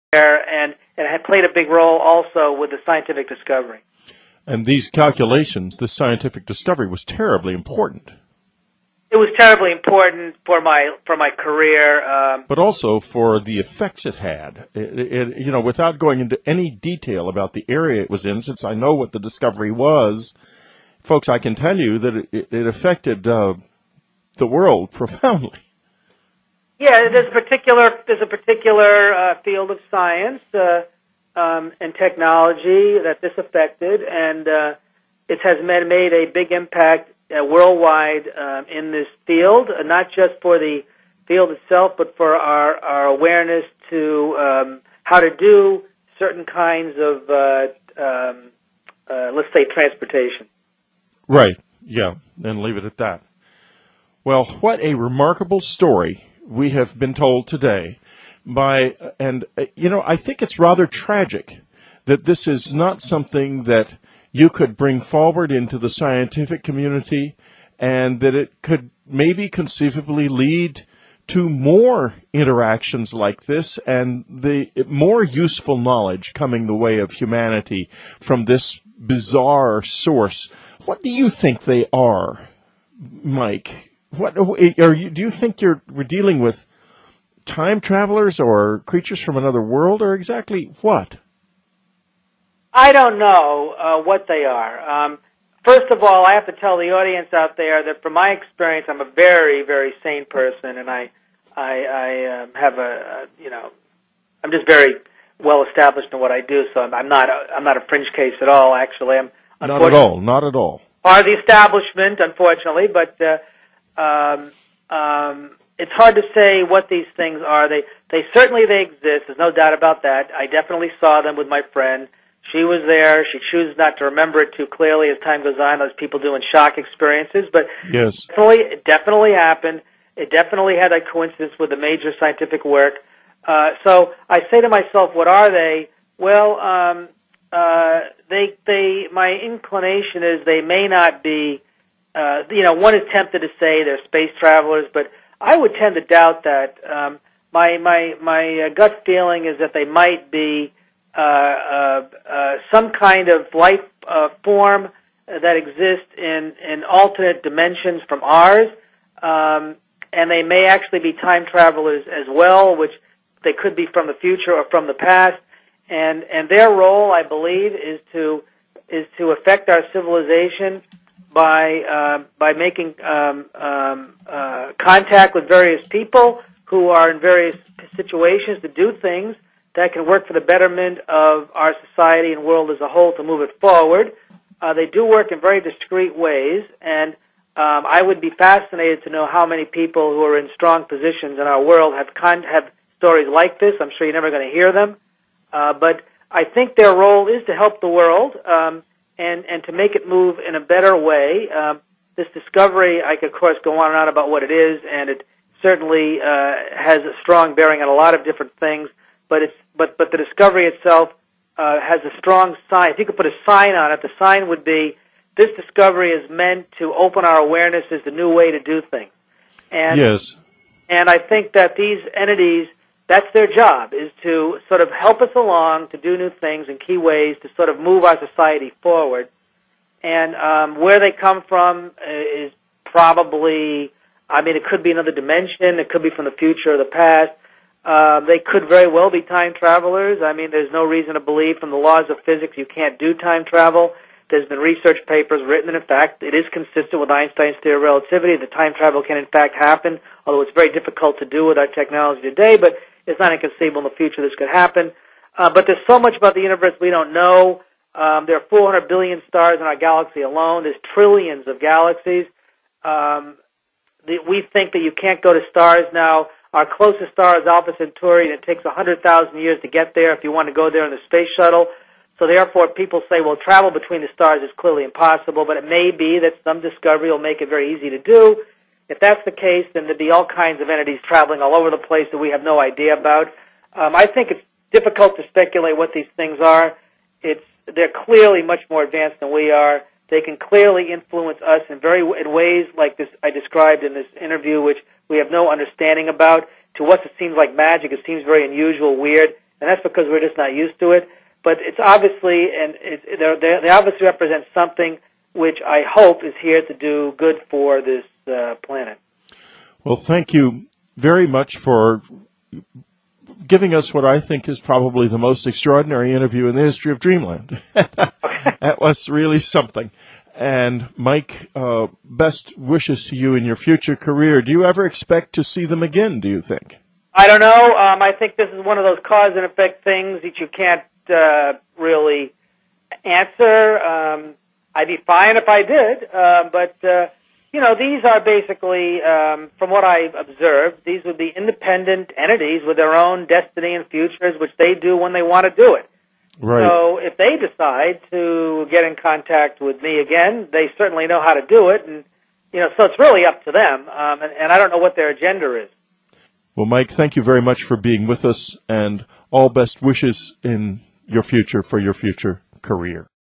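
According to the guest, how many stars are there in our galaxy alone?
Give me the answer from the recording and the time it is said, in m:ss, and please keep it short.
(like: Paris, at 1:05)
400 billion, at 4:18.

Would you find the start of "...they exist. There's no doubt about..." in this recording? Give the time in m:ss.
1:58.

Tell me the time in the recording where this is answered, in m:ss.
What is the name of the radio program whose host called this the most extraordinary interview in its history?
5:16.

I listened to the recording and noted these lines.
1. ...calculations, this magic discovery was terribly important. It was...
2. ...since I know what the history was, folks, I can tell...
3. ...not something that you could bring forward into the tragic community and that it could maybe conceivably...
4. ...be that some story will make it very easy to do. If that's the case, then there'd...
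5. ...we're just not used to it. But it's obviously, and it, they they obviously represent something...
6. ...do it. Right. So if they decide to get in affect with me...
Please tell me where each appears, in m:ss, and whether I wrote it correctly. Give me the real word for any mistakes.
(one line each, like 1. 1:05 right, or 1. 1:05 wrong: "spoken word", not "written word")
1. 0:04 wrong: "scientific", not "magic"
2. 0:18 wrong: "discovery", not "history"
3. 1:02 wrong: "scientific", not "tragic"
4. 4:35 wrong: "discovery", not "story"
5. 5:00 right
6. 5:45 wrong: "contact", not "affect".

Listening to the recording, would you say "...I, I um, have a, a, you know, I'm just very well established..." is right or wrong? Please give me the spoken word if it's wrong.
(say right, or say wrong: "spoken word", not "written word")
right.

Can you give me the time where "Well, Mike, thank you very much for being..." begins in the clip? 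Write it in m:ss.
5:56.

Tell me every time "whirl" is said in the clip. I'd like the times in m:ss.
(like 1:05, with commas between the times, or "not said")
not said.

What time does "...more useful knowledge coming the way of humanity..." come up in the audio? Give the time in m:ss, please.
1:14.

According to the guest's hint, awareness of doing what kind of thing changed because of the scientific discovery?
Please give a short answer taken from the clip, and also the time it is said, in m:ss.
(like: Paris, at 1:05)
transportation, at 0:49.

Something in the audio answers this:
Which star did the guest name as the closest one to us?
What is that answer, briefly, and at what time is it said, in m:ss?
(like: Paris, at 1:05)
Alpha Centauri, at 4:27.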